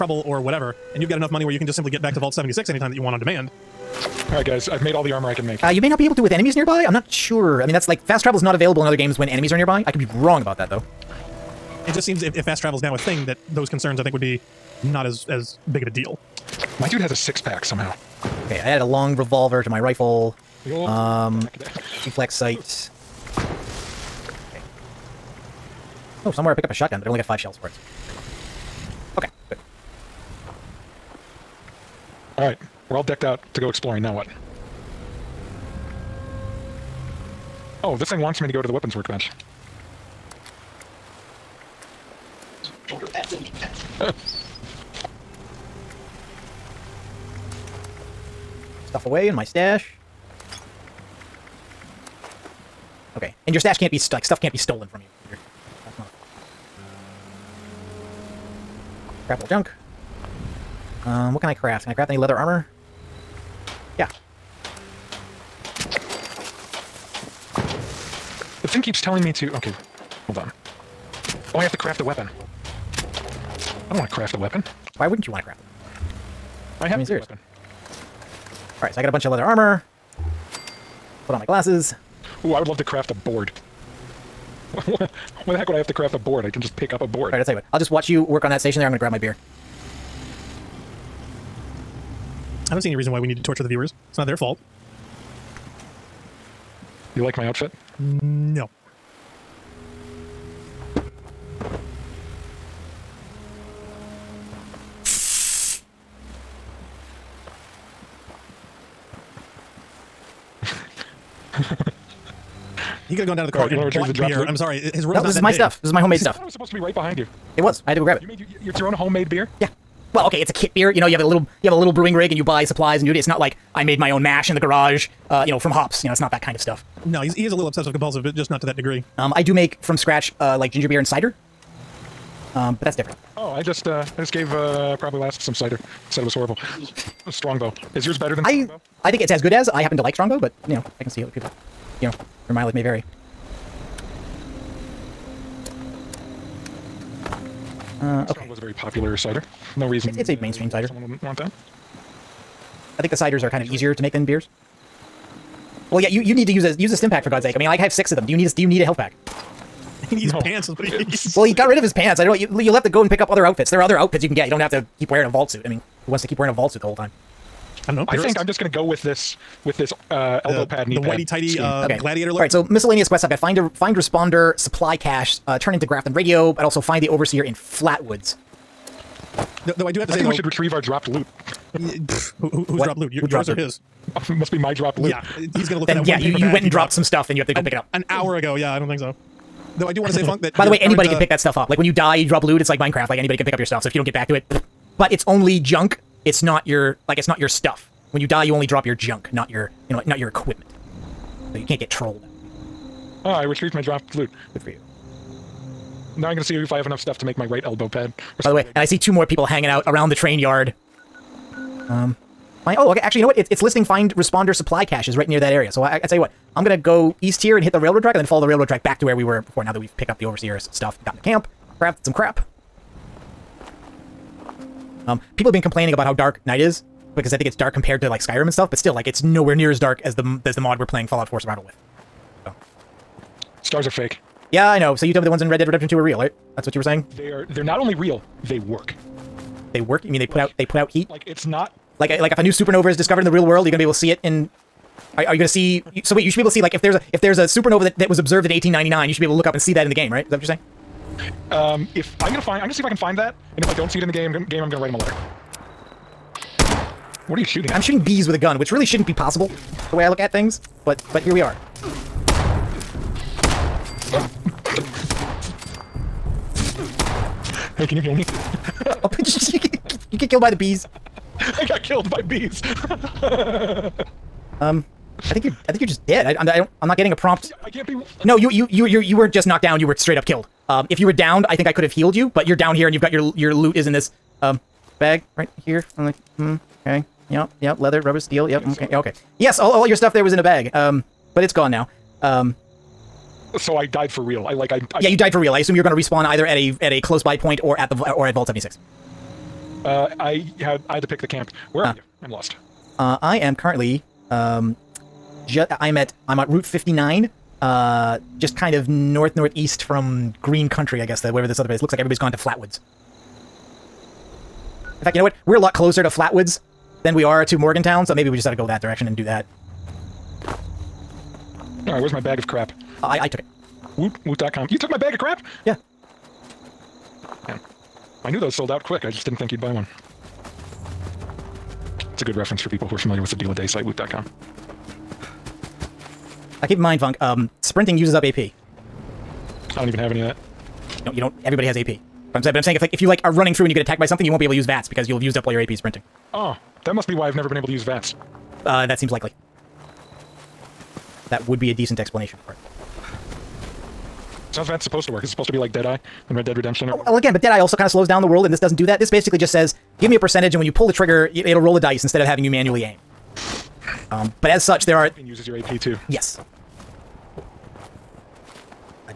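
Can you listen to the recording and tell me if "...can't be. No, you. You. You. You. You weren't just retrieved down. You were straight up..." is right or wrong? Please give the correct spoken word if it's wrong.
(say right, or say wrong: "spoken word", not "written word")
wrong: "knocked", not "retrieved".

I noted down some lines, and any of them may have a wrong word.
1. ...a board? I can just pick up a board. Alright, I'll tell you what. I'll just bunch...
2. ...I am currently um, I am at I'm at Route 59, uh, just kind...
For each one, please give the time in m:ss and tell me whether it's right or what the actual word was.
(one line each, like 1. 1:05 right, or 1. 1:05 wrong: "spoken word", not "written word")
1. 1:26 wrong: "watch", not "bunch"
2. 5:03 right.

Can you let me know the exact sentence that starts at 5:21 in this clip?
Alright, where's my bag of crap?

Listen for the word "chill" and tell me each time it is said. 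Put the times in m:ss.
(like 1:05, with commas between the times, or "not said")
not said.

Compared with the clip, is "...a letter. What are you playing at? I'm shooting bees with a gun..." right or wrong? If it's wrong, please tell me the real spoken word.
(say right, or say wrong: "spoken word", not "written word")
wrong: "shooting", not "playing".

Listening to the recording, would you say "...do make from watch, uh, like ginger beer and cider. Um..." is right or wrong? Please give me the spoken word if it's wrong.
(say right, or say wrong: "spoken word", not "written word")
wrong: "scratch", not "watch".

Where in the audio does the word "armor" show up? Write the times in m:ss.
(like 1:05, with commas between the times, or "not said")
0:05, 1:02, 1:19.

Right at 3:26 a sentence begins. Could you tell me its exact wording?
Now I'm going to see if I have enough stuff to make my right elbow pad.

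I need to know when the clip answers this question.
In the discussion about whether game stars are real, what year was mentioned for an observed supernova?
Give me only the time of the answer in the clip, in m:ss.
4:08.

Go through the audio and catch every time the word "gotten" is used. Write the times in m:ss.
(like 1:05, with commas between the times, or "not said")
3:41.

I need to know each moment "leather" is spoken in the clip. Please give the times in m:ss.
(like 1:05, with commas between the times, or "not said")
1:02, 1:19, 4:47.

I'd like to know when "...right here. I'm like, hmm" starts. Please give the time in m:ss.
4:45.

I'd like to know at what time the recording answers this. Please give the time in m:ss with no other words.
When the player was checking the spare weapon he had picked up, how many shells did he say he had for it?
0:27.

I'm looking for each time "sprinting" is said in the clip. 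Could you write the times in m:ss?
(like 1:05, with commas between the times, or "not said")
5:37, 5:45.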